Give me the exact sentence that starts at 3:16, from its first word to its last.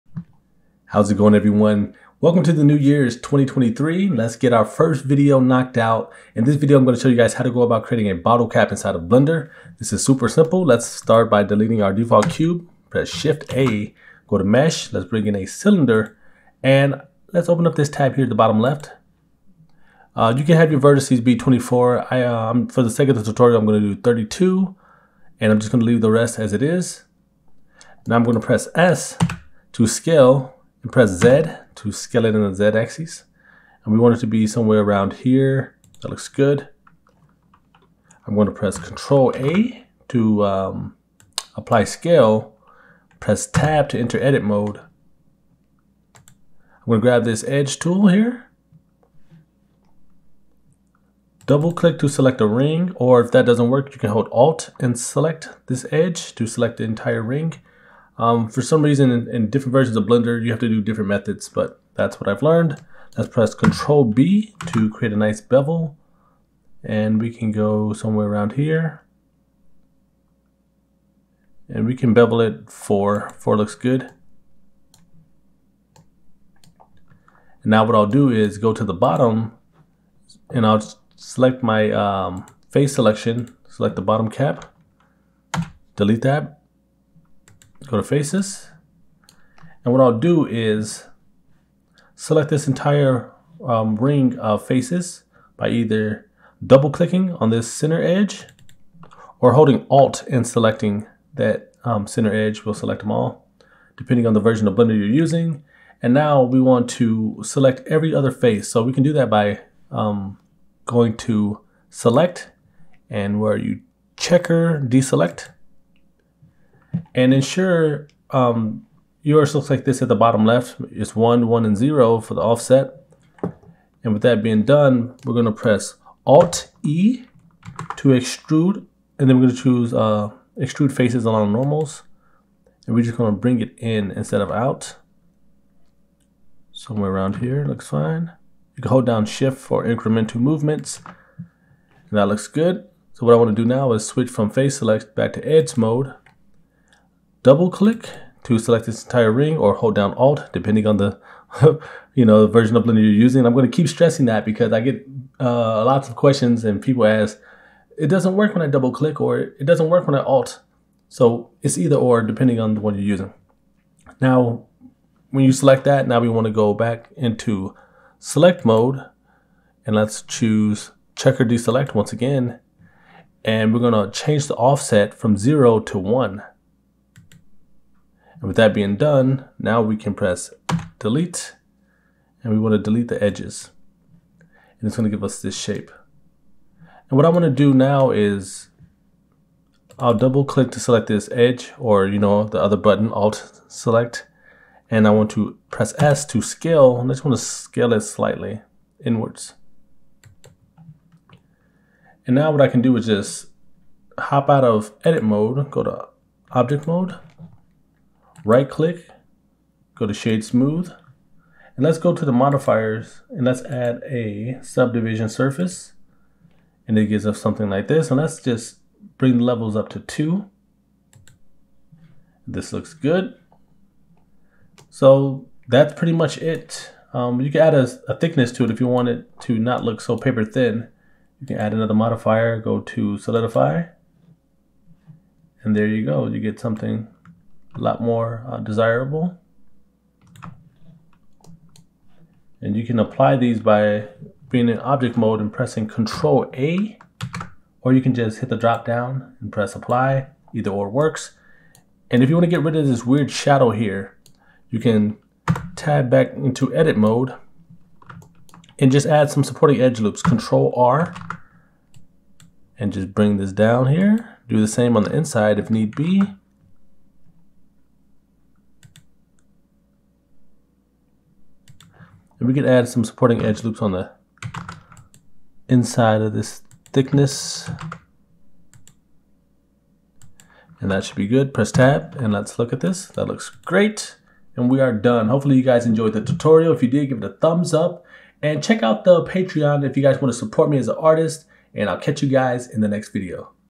And I just want to scale it slightly inwards.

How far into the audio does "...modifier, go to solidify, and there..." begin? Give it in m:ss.
3:51.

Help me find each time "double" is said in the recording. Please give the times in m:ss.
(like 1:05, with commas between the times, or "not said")
0:51, 1:36, 2:27, 2:38, 3:10.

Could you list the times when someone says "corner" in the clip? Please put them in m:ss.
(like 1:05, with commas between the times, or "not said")
not said.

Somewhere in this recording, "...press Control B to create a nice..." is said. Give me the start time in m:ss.
1:03.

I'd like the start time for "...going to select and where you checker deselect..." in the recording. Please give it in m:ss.
1:50.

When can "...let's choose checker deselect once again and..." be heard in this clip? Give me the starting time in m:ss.
2:49.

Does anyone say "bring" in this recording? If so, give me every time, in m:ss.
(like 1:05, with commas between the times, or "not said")
0:15, 2:13, 3:39, 4:23.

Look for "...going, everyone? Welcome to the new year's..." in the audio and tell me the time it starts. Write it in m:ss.
0:01.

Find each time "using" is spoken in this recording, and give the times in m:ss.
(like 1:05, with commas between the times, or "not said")
1:45, 2:33, 2:43.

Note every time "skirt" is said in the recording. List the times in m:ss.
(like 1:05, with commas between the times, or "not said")
not said.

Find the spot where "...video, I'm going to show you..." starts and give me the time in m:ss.
0:06.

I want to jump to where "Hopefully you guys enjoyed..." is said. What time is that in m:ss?
4:45.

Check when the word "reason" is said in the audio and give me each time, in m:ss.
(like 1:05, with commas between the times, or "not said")
0:58.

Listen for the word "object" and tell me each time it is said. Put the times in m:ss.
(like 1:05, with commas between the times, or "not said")
3:26, 4:04.